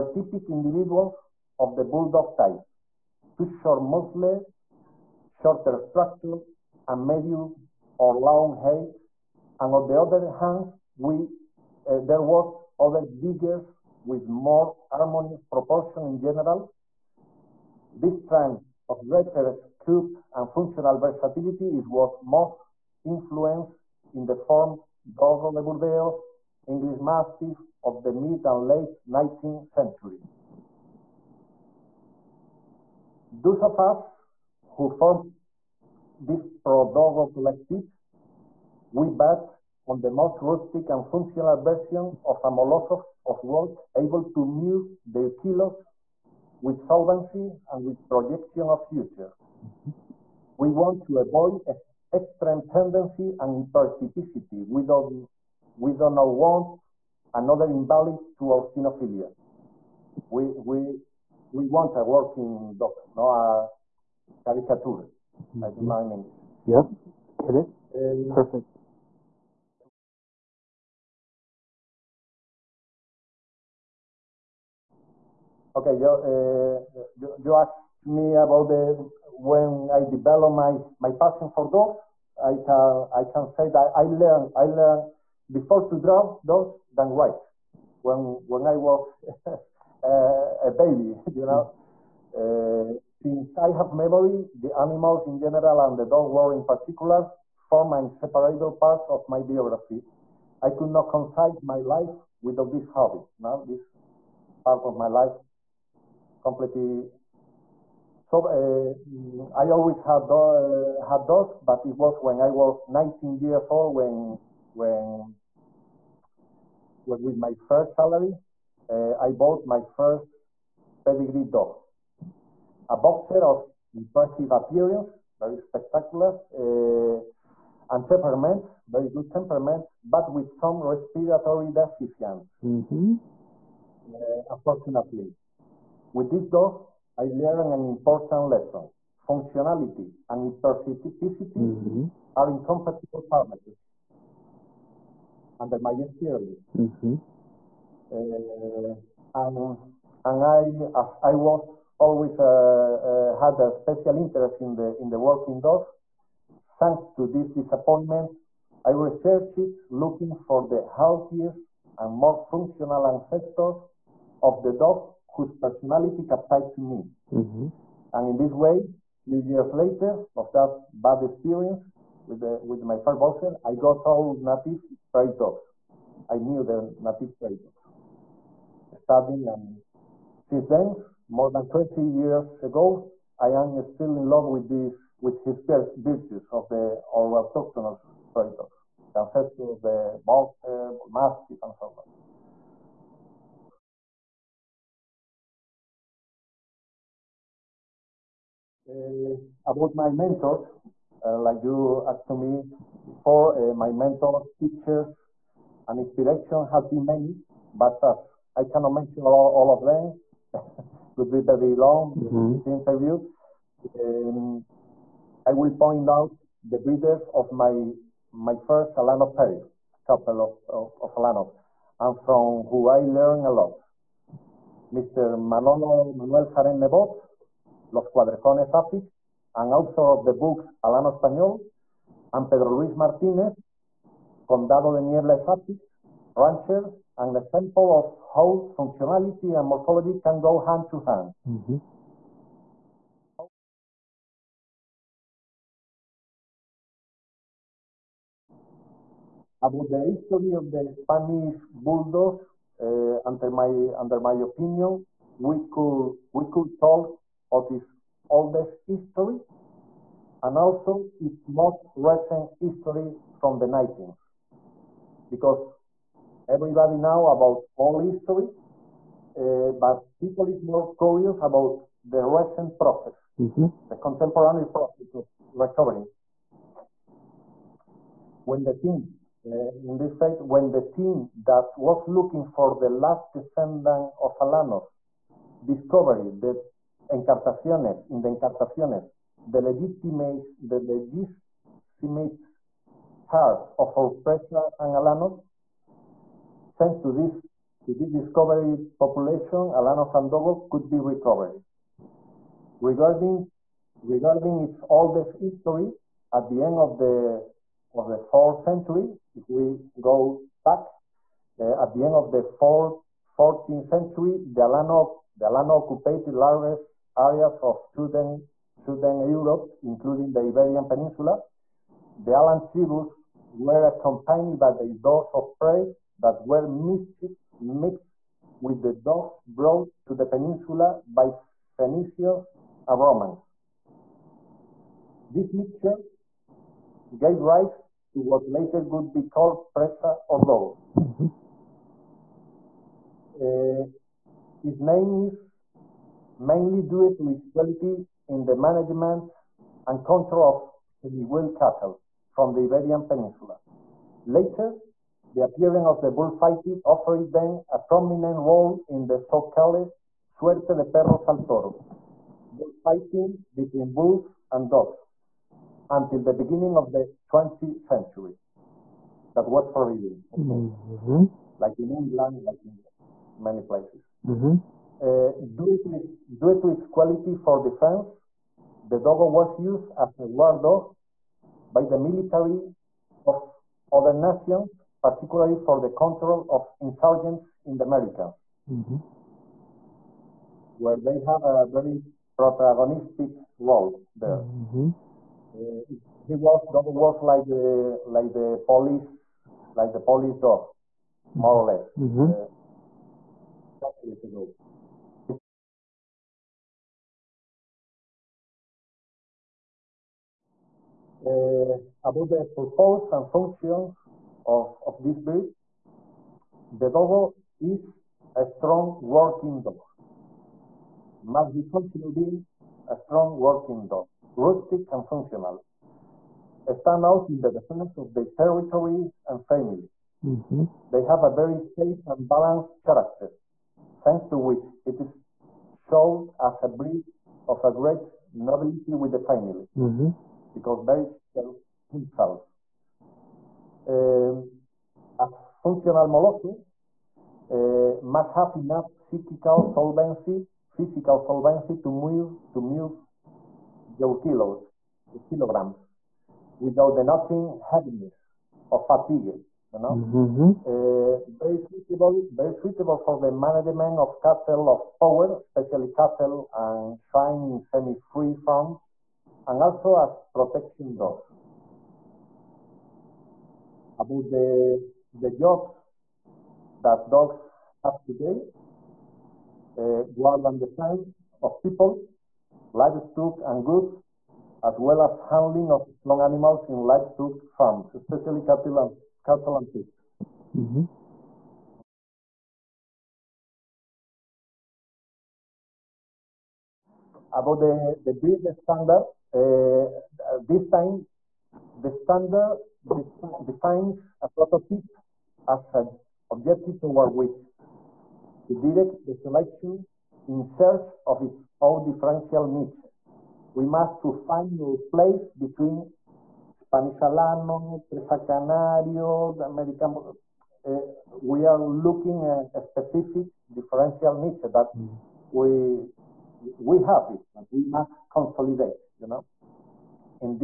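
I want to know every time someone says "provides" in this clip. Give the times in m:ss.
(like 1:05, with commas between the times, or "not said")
not said.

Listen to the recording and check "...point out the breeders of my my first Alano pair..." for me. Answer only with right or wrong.
right.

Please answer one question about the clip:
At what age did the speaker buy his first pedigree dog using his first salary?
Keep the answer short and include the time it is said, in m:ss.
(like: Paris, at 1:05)
19, at 1:52.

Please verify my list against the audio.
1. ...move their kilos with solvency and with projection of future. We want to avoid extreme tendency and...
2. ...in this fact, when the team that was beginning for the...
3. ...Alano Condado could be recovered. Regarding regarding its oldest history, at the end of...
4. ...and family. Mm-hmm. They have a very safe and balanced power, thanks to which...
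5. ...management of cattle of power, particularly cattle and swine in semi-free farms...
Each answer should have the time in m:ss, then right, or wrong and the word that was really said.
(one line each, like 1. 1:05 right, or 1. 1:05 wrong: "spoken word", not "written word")
1. 0:44 right
2. 4:39 wrong: "looking", not "beginning"
3. 4:59 wrong: "Sandogo", not "Condado"
4. 7:09 wrong: "character", not "power"
5. 7:43 wrong: "especially", not "particularly".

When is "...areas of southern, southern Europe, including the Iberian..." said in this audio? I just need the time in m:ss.
5:17.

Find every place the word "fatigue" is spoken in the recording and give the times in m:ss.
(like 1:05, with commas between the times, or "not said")
7:38.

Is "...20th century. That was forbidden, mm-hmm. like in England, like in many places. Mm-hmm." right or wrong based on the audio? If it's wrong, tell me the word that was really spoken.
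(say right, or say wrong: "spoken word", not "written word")
right.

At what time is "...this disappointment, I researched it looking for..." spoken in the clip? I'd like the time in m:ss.
2:37.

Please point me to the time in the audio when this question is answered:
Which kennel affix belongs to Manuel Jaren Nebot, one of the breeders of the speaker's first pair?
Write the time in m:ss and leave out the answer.
3:47.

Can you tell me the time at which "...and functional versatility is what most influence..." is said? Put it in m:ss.
0:20.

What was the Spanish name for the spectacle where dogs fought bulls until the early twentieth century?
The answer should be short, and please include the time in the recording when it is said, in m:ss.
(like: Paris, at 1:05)
suerte de perros al toro, at 6:00.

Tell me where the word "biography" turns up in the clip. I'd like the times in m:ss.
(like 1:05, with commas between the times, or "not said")
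1:39.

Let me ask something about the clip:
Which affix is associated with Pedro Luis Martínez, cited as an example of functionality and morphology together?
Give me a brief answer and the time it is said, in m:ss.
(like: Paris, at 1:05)
Condado de Niebla, at 3:54.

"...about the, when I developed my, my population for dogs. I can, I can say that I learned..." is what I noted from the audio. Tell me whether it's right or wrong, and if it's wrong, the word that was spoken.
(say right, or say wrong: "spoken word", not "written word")
wrong: "passion", not "population".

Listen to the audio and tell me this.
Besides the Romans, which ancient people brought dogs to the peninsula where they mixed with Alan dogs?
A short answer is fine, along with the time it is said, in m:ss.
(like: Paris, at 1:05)
Phoenicians, at 5:31.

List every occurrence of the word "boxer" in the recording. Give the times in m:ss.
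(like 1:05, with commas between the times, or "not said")
2:02, 2:53, 3:10.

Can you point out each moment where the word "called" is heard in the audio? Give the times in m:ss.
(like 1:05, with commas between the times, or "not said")
5:39, 5:59.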